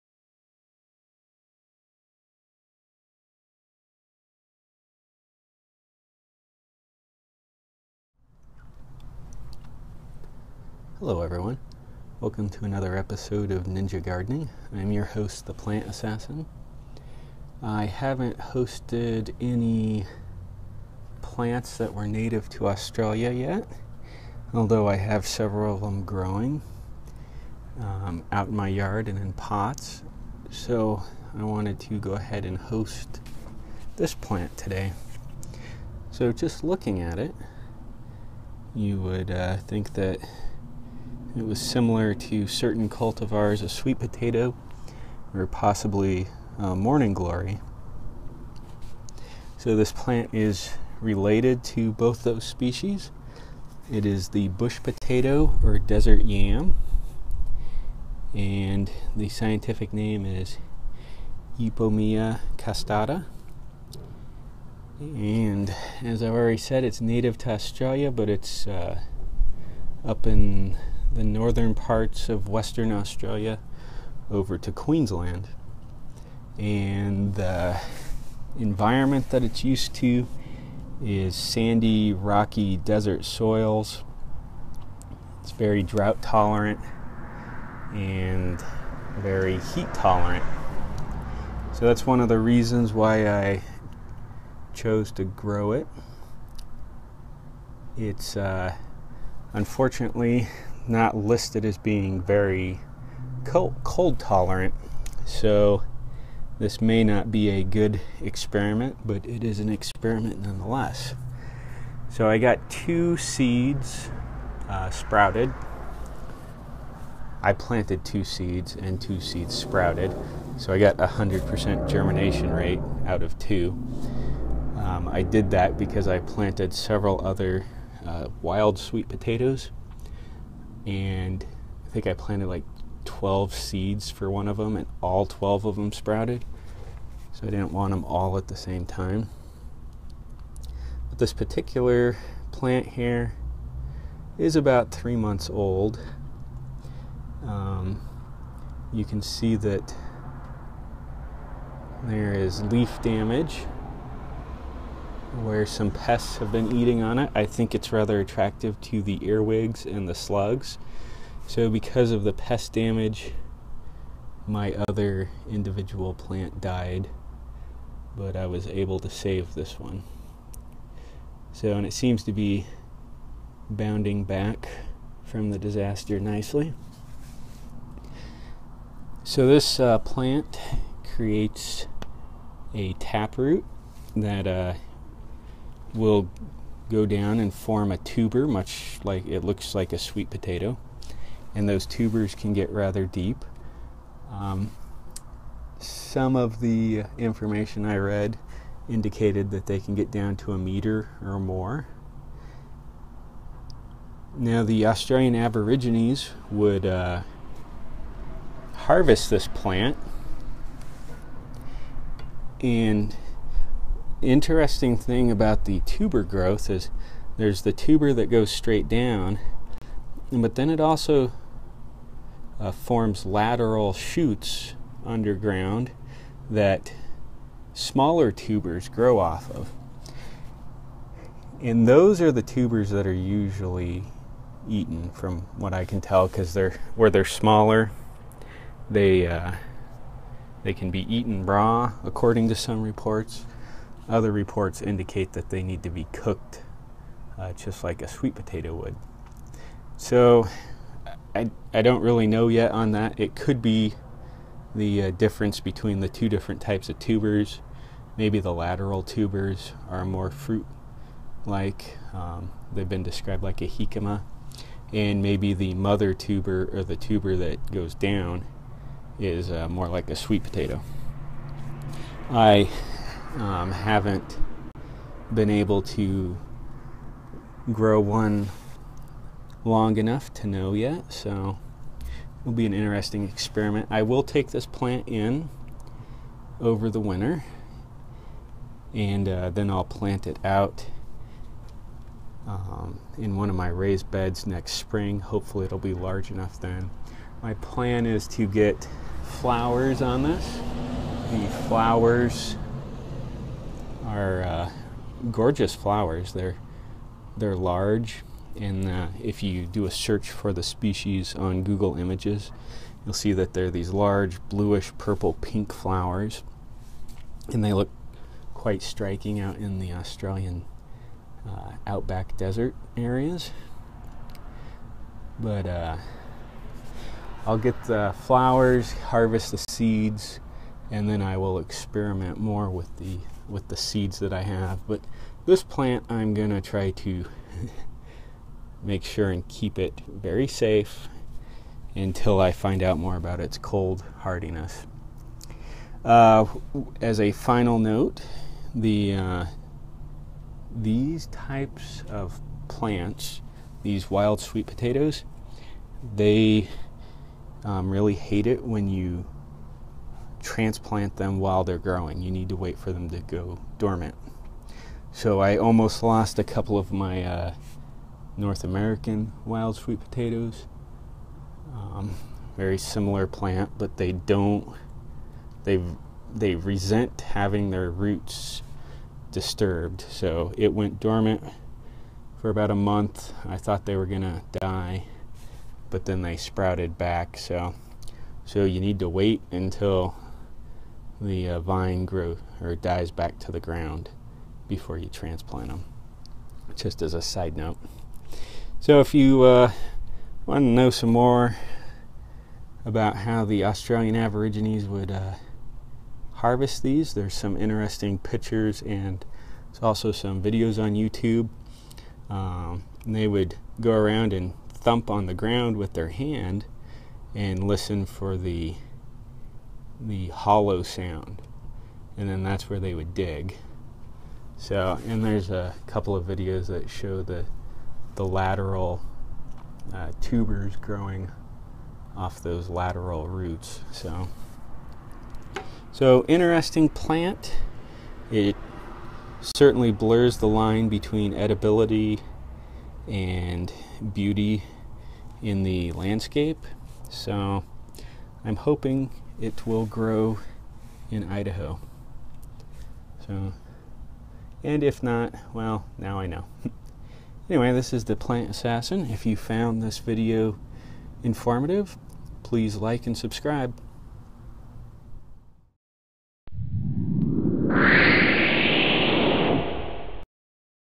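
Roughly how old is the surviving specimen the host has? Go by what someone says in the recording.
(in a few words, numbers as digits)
three months.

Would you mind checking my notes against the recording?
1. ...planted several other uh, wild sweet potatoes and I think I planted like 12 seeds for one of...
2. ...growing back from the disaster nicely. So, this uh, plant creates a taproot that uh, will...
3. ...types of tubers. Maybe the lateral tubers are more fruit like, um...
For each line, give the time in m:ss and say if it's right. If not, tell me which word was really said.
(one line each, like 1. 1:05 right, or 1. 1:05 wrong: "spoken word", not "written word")
1. 2:06 right
2. 2:53 wrong: "bounding", not "growing"
3. 4:16 right.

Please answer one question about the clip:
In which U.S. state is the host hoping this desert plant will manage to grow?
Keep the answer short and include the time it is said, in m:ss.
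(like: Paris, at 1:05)
Idaho, at 7:31.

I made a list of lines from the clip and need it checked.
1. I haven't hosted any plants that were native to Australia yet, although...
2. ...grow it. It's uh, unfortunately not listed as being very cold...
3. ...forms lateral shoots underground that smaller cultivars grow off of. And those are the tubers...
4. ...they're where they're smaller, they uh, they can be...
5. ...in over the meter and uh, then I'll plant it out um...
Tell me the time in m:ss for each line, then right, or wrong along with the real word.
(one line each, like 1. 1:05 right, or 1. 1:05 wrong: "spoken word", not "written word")
1. 0:17 right
2. 1:35 right
3. 3:42 wrong: "tubers", not "cultivars"
4. 3:56 right
5. 4:45 wrong: "winter", not "meter".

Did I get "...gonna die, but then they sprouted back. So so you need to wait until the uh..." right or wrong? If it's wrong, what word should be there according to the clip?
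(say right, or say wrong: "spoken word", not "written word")
right.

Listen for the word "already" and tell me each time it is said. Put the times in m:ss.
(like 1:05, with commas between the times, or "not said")
1:06.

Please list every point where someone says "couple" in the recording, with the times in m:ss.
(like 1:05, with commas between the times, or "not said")
6:06, 7:05.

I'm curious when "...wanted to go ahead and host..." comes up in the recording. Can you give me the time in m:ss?
0:31.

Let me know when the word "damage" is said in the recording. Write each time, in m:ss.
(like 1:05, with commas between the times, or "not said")
2:33, 2:42.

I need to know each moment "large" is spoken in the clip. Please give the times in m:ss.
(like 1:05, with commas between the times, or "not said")
4:55, 5:07, 5:13.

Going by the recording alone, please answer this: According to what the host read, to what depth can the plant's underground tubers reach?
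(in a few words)
a meter.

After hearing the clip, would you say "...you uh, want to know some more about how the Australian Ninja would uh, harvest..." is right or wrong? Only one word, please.
wrong.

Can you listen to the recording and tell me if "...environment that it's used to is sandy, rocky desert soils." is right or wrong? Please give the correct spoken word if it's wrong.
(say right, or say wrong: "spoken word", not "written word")
right.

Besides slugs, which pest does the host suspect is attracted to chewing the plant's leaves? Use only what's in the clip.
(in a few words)
earwigs.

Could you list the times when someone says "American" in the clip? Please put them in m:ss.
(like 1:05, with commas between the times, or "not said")
6:08.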